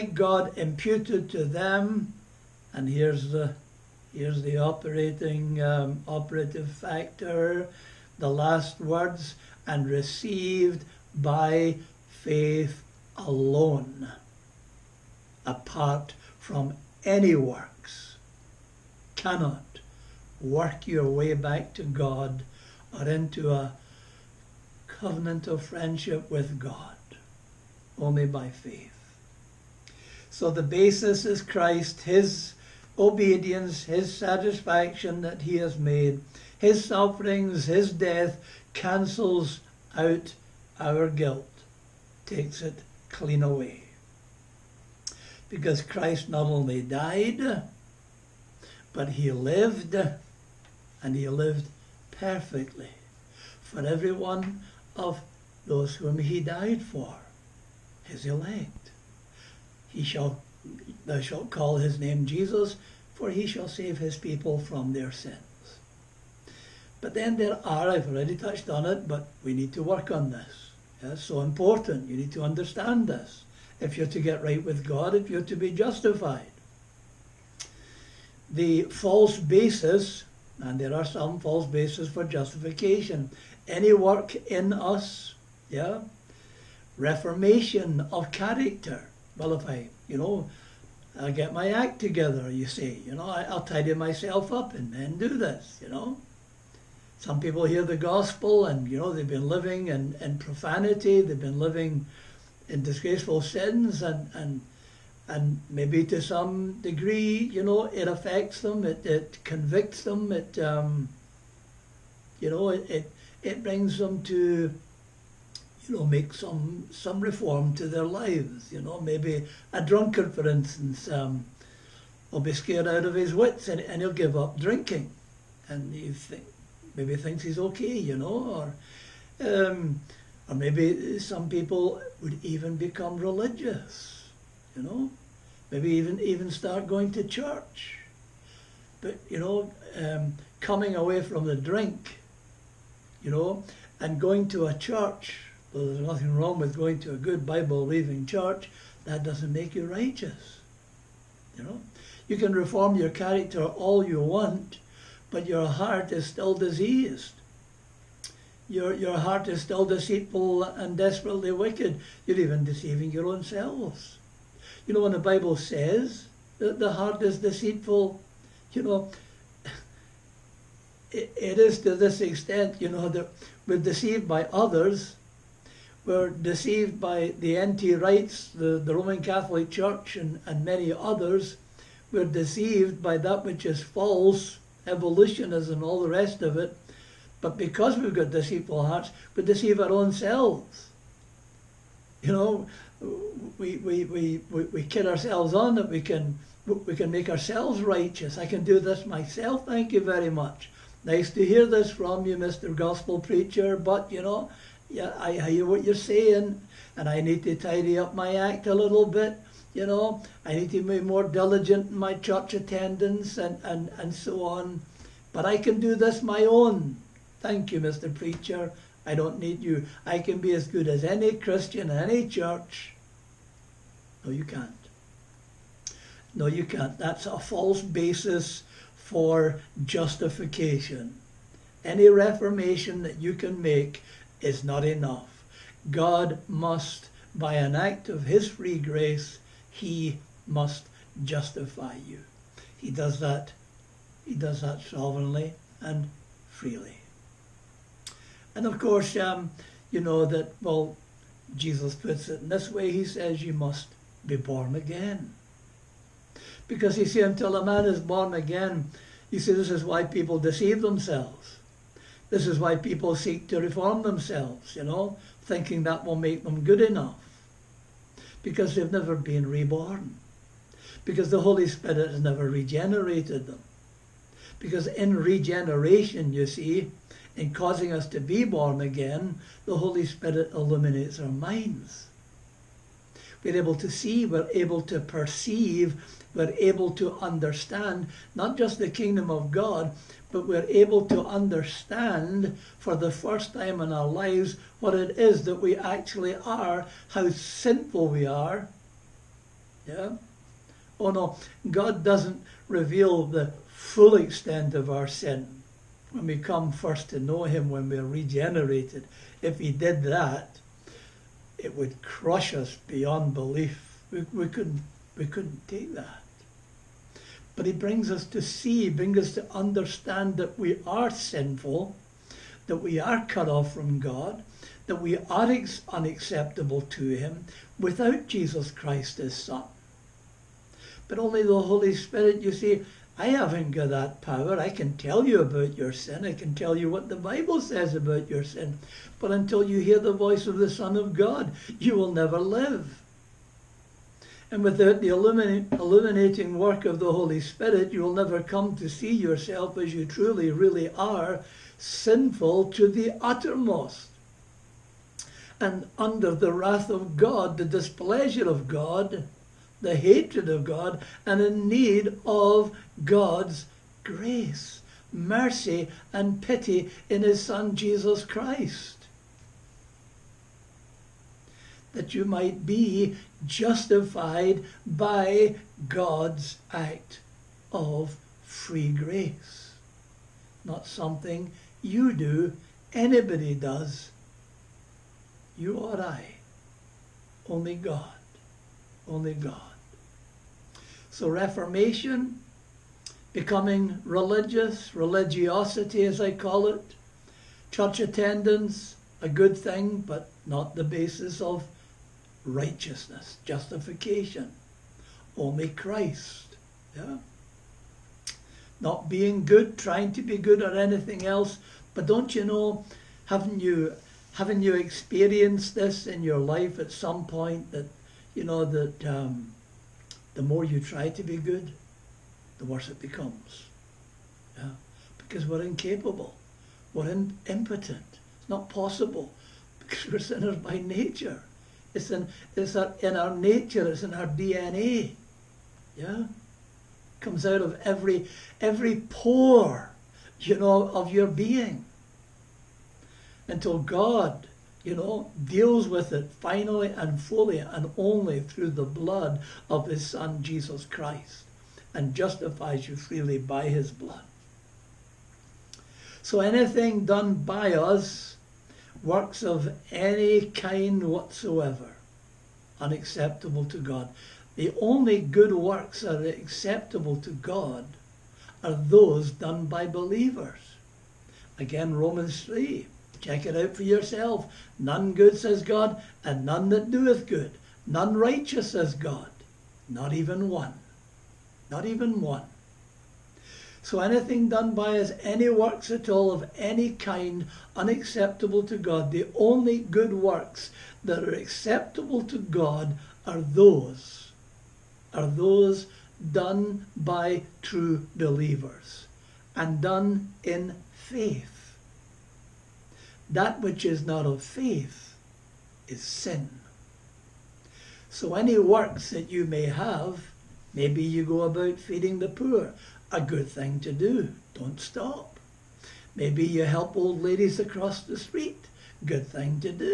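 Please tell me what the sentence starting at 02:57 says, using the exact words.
Wrights, the, the Roman Catholic Church, and, and many others.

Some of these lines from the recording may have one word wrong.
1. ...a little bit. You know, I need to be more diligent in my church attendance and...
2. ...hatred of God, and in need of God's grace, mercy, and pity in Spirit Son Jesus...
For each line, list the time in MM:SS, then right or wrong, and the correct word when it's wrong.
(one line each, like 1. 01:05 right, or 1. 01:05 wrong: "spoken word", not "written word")
1. 03:28 right
2. 05:59 wrong: "His", not "Spirit".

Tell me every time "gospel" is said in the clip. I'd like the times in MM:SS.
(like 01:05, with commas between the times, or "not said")
01:37, 03:22.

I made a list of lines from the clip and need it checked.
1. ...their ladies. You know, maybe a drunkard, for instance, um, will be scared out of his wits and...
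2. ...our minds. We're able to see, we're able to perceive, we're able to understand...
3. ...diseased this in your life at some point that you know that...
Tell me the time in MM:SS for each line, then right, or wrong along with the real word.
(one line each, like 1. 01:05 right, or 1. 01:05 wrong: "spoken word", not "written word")
1. 01:57 wrong: "lives", not "ladies"
2. 04:41 right
3. 06:54 wrong: "experienced", not "diseased".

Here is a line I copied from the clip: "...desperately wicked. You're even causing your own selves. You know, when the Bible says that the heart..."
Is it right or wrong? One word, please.
wrong.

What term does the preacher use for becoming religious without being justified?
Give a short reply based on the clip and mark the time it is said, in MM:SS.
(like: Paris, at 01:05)
Religiosity, at 06:34.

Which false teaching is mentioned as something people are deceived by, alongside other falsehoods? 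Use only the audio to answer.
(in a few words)
Evolutionism.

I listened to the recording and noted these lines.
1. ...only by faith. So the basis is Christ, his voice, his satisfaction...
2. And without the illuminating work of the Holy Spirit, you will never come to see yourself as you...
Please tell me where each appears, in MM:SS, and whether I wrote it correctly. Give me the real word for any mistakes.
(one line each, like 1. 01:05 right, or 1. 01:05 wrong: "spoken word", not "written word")
1. 00:27 wrong: "obedience", not "voice"
2. 05:44 right.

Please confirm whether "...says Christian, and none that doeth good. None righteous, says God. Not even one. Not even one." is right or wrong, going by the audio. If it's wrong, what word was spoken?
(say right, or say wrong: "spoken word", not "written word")
wrong: "God", not "Christian".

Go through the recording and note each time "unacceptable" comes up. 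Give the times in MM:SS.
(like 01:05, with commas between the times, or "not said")
05:25, 07:42, 08:07.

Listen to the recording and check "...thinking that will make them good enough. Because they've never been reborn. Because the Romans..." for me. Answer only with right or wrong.
wrong.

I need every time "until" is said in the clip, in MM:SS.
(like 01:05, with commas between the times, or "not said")
04:17, 05:39, 07:23.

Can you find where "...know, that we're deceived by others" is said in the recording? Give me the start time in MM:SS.
02:52.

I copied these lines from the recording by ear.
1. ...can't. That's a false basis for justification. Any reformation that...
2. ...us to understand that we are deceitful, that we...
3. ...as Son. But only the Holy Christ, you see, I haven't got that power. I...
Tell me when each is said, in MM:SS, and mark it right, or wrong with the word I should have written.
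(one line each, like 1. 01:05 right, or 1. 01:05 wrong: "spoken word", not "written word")
1. 03:46 right
2. 05:19 wrong: "sinful", not "deceitful"
3. 05:29 wrong: "Spirit", not "Christ".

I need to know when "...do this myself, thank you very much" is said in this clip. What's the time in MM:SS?
03:18.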